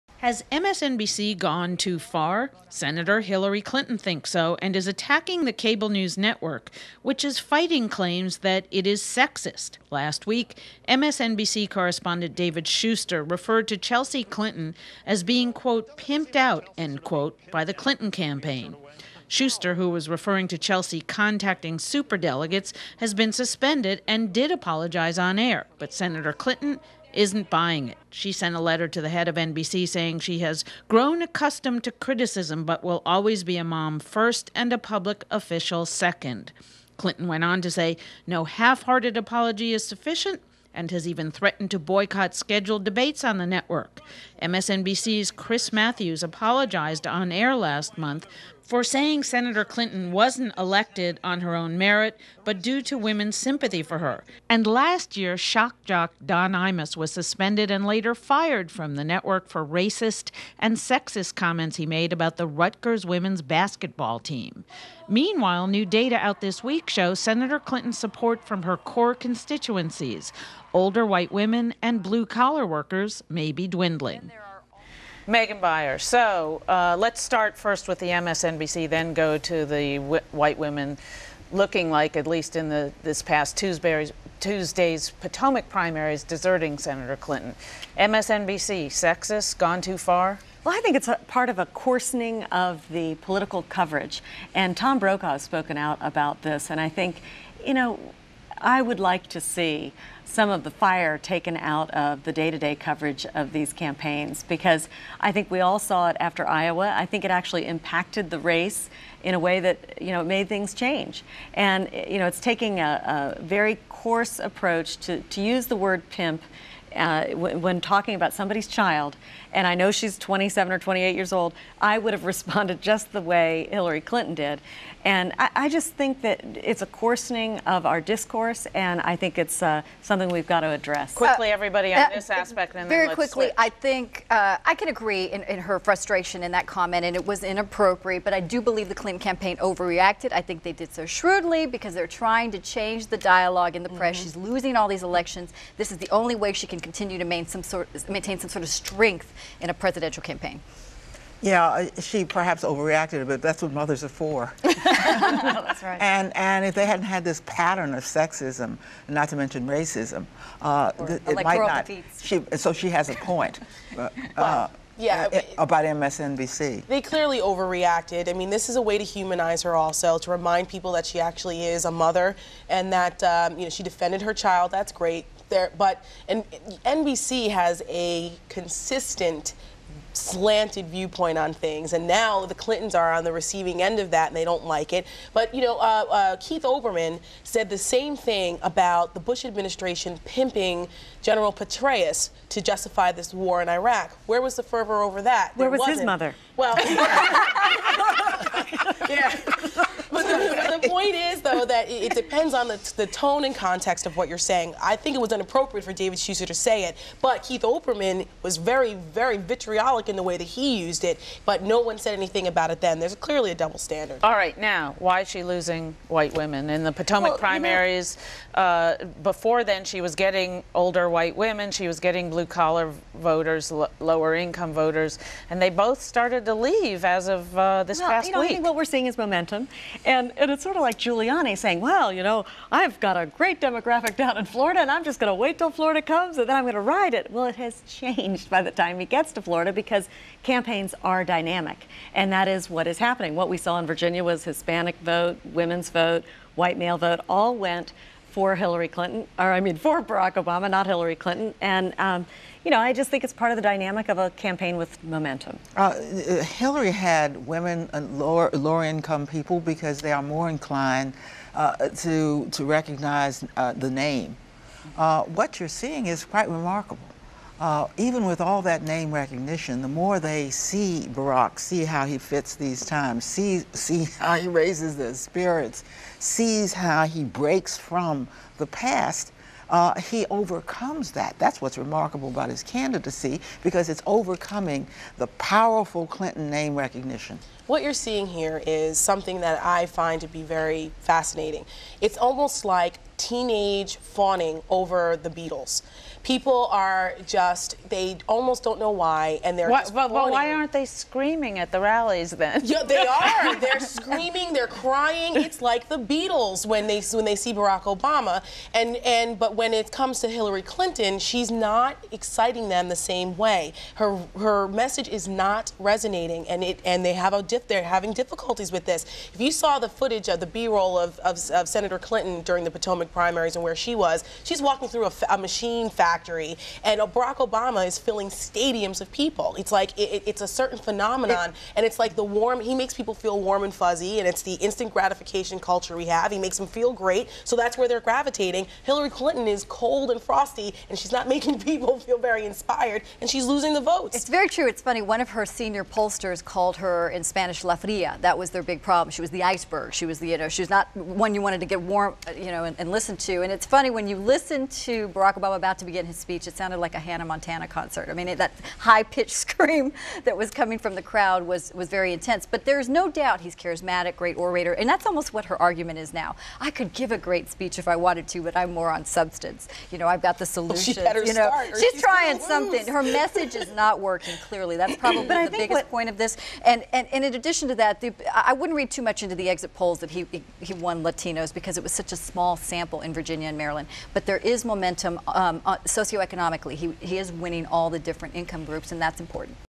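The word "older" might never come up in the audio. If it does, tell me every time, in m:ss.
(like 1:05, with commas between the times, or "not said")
1:10, 3:40.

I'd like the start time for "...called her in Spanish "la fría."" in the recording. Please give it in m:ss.
5:46.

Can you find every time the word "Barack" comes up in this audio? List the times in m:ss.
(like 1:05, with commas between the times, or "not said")
4:10, 4:31, 5:07, 5:27, 5:55.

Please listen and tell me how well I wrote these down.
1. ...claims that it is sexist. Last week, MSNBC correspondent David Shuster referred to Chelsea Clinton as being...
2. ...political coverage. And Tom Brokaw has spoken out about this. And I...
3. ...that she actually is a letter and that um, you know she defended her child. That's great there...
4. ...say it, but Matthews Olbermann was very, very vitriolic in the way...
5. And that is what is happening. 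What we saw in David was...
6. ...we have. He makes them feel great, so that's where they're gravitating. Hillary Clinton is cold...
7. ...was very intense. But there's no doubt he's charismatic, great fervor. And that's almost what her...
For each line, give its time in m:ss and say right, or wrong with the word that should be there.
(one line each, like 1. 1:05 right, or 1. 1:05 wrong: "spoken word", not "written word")
1. 0:07 right
2. 1:33 right
3. 2:50 wrong: "mother", not "letter"
4. 3:26 wrong: "Keith", not "Matthews"
5. 4:02 wrong: "Virginia", not "David"
6. 5:35 right
7. 6:01 wrong: "orator", not "fervor".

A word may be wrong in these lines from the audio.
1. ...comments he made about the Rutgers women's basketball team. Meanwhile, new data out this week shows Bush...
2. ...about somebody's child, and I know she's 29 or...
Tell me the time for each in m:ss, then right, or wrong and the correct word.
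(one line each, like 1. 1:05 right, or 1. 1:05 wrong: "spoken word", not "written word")
1. 1:01 wrong: "Senator", not "Bush"
2. 1:58 wrong: "27", not "29".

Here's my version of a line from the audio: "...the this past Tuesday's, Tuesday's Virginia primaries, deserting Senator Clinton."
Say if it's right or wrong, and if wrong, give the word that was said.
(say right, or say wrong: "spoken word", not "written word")
wrong: "Potomac", not "Virginia".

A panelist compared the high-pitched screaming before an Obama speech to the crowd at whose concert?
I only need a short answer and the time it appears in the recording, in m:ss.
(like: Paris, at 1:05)
Hannah Montana, at 5:56.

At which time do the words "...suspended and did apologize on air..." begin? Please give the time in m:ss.
0:23.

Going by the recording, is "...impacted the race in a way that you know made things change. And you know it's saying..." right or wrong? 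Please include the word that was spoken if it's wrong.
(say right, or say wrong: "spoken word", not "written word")
wrong: "taking", not "saying".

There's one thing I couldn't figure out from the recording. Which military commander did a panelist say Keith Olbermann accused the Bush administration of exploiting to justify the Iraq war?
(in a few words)
General Petraeus.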